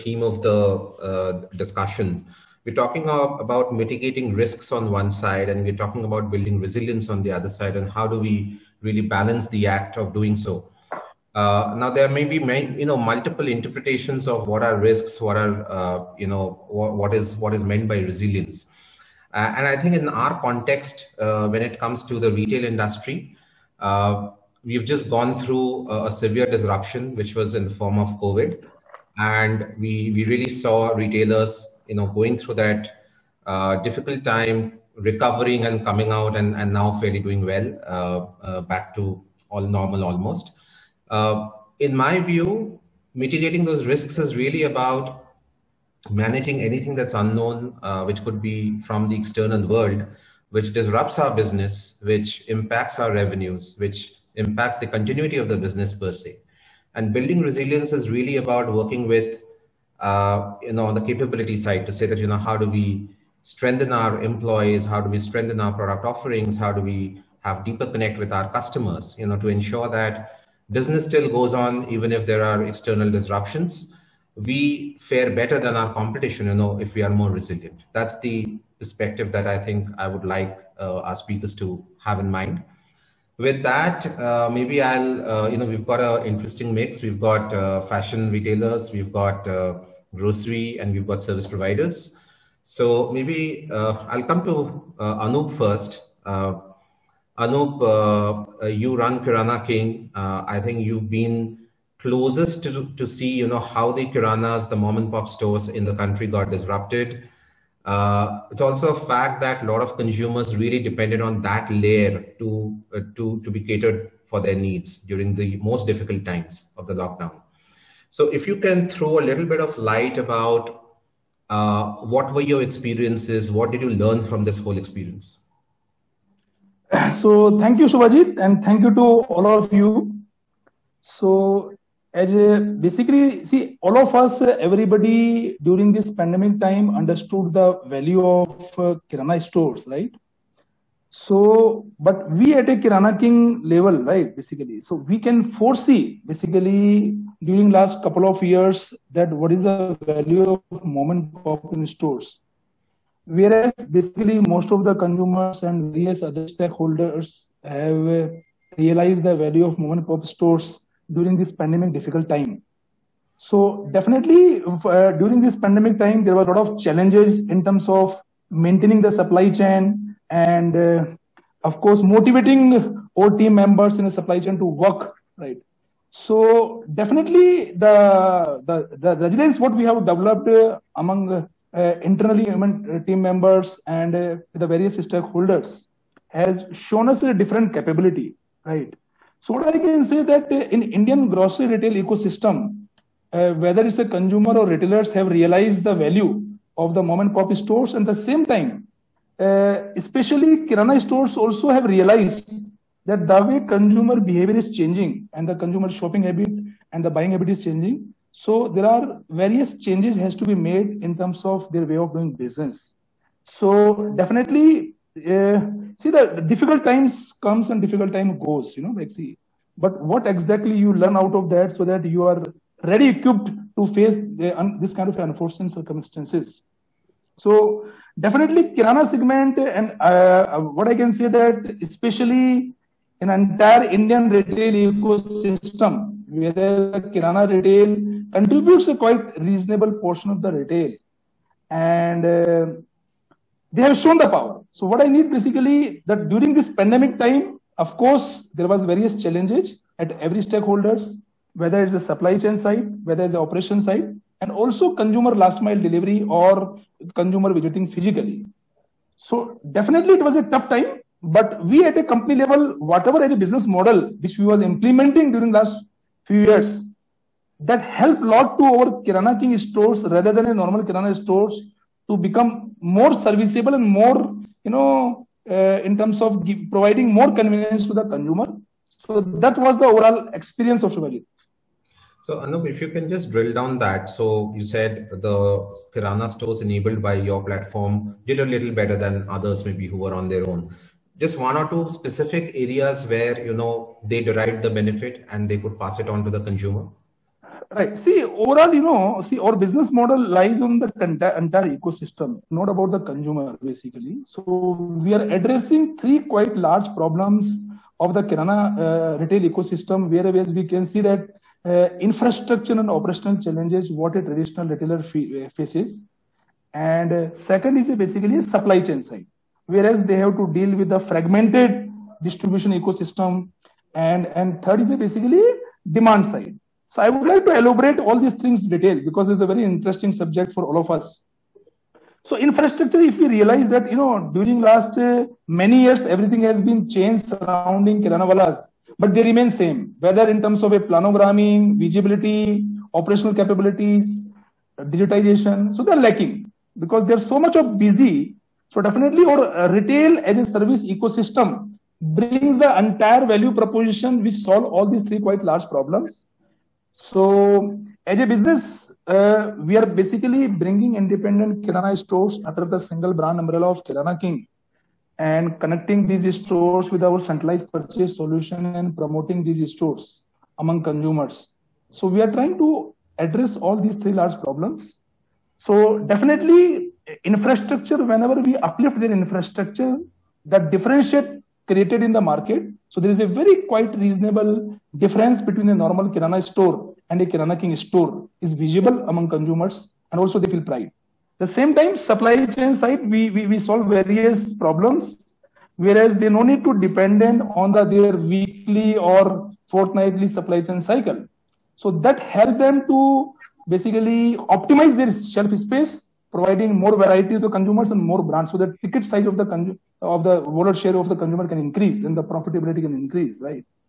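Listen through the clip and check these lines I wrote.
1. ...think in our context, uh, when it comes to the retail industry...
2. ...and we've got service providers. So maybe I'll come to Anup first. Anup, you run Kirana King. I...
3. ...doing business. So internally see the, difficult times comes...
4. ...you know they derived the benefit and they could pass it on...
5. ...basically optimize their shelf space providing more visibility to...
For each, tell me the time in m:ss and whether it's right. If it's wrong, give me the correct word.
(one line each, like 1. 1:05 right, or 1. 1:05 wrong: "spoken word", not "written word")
1. 0:19 right
2. 1:30 right
3. 3:32 wrong: "definitely", not "internally"
4. 4:53 right
5. 6:43 wrong: "variety", not "visibility".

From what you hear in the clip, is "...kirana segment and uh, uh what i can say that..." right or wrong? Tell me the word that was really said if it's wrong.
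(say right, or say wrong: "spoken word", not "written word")
right.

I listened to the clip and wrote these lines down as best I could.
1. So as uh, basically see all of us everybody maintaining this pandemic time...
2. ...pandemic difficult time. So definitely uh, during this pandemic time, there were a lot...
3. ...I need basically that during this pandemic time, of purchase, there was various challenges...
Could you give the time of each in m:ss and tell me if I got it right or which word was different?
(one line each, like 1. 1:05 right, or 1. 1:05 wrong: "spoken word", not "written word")
1. 2:11 wrong: "during", not "maintaining"
2. 2:41 right
3. 4:05 wrong: "course", not "purchase".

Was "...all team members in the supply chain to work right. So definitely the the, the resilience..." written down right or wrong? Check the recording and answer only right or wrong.
right.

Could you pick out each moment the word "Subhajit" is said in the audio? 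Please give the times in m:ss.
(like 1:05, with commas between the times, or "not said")
2:07, 4:40.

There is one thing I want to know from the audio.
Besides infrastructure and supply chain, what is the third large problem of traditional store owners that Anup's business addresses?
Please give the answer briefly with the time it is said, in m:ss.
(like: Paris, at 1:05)
demand side, at 5:25.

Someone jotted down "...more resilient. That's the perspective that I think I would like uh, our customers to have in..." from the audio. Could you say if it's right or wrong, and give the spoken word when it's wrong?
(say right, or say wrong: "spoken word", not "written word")
wrong: "speakers", not "customers".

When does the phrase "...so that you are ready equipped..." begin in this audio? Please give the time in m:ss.
3:41.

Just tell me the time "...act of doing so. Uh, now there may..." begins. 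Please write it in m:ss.
0:09.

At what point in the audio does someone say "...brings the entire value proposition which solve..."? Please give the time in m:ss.
5:52.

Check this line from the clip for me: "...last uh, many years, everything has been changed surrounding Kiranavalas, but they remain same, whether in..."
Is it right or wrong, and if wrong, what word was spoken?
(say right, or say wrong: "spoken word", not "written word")
right.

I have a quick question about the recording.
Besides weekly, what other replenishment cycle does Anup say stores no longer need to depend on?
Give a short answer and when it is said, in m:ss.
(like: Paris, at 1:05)
fortnightly, at 6:39.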